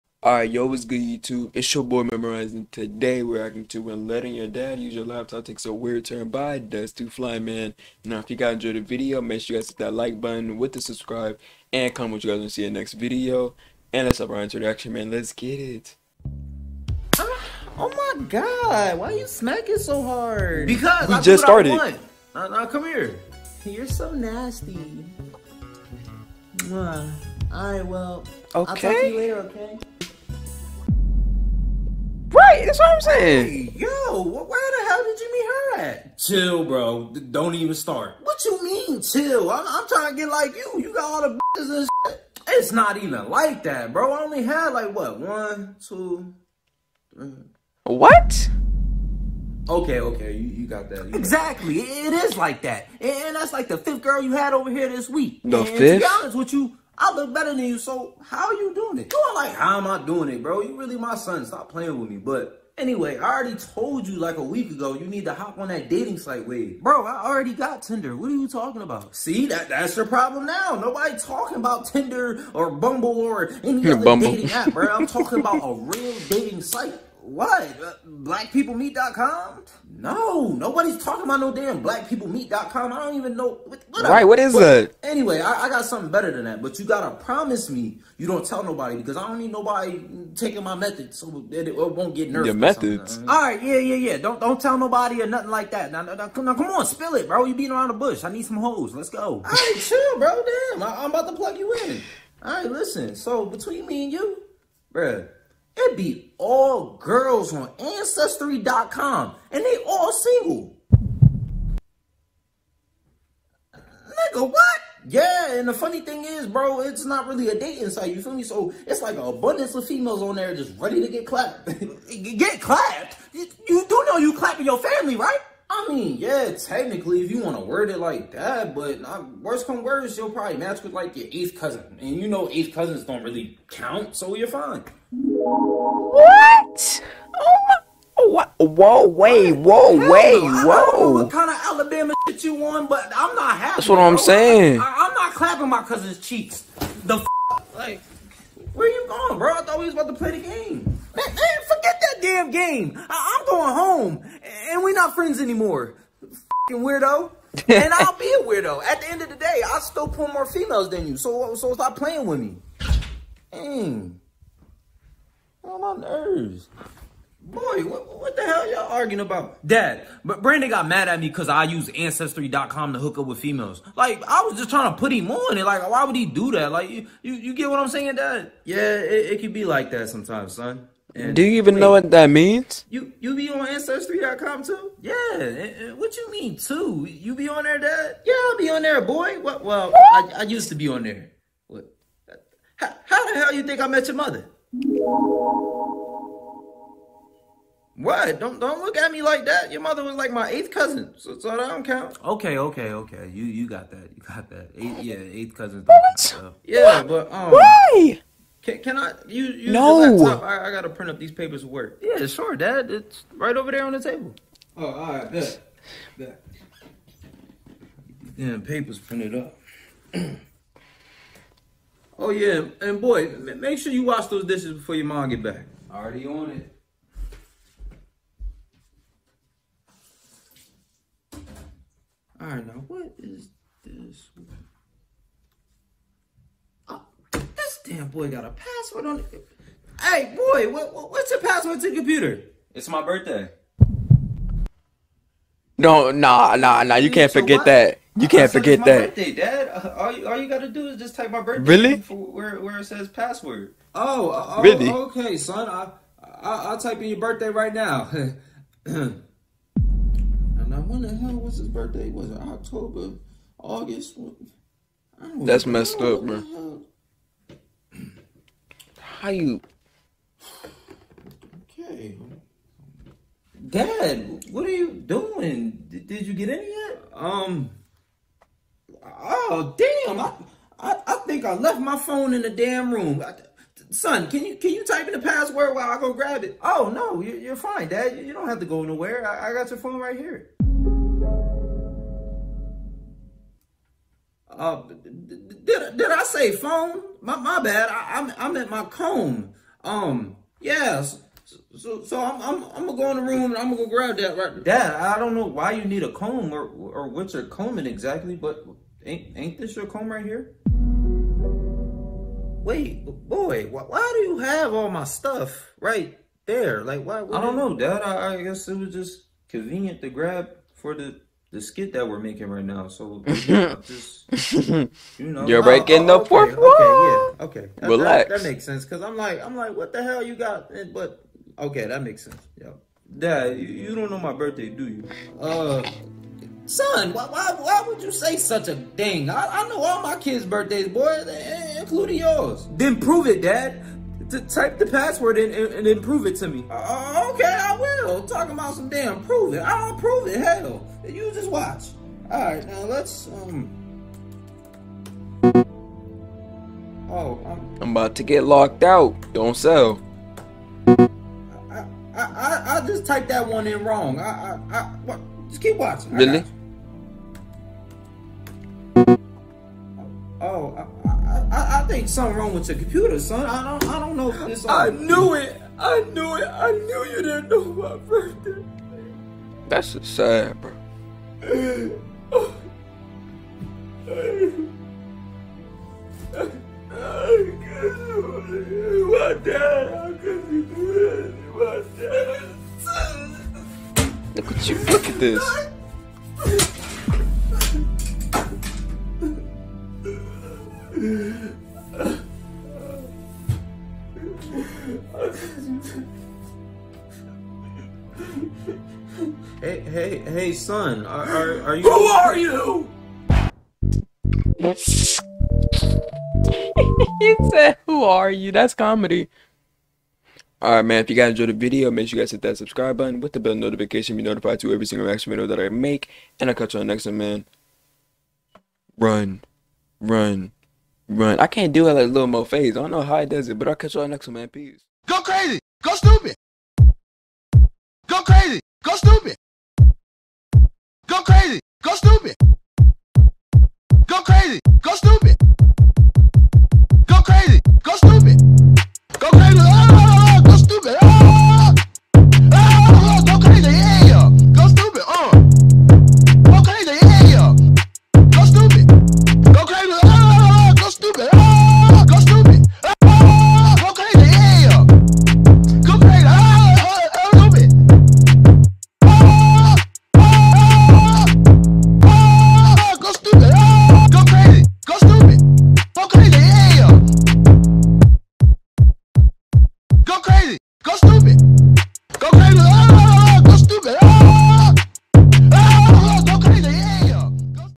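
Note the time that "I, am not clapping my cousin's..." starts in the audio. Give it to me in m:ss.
2:24.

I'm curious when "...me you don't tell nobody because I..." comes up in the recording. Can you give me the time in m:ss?
1:27.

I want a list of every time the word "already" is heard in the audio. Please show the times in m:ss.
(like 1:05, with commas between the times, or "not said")
1:03, 1:07, 3:45.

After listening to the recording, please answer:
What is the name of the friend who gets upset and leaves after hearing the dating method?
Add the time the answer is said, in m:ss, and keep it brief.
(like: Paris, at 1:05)
Brandon, at 2:50.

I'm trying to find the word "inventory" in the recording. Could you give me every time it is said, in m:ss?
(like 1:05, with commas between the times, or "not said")
not said.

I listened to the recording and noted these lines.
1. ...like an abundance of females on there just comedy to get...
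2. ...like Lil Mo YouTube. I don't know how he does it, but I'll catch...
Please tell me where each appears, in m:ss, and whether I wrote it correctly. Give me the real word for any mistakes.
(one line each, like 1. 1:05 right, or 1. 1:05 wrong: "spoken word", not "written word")
1. 1:59 wrong: "ready", not "comedy"
2. 7:11 wrong: "Phase", not "YouTube".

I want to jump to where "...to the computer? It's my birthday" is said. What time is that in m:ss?
4:01.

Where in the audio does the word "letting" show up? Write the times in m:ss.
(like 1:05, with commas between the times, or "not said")
0:04.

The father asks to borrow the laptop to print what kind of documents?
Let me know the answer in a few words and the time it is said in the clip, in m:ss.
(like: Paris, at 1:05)
papers of work, at 3:31.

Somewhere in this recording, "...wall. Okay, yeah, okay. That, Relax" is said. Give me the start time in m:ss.
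5:26.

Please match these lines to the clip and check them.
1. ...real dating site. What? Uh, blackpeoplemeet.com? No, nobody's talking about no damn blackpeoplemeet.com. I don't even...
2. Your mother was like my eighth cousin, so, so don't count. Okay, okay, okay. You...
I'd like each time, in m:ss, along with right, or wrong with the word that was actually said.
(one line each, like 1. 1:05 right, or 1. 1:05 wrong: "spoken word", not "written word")
1. 1:15 right
2. 3:19 right.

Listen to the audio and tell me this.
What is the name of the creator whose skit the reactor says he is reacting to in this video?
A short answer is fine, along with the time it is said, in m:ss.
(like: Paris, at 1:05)
Dez2fly, at 0:06.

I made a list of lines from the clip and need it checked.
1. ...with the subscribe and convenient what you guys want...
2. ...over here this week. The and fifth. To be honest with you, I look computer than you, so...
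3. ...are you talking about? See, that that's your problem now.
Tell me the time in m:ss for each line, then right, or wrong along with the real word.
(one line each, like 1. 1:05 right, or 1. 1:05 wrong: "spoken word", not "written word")
1. 0:10 wrong: "comment", not "convenient"
2. 0:54 wrong: "better", not "computer"
3. 1:08 right.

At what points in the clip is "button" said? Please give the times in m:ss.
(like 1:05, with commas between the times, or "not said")
0:10, 7:02.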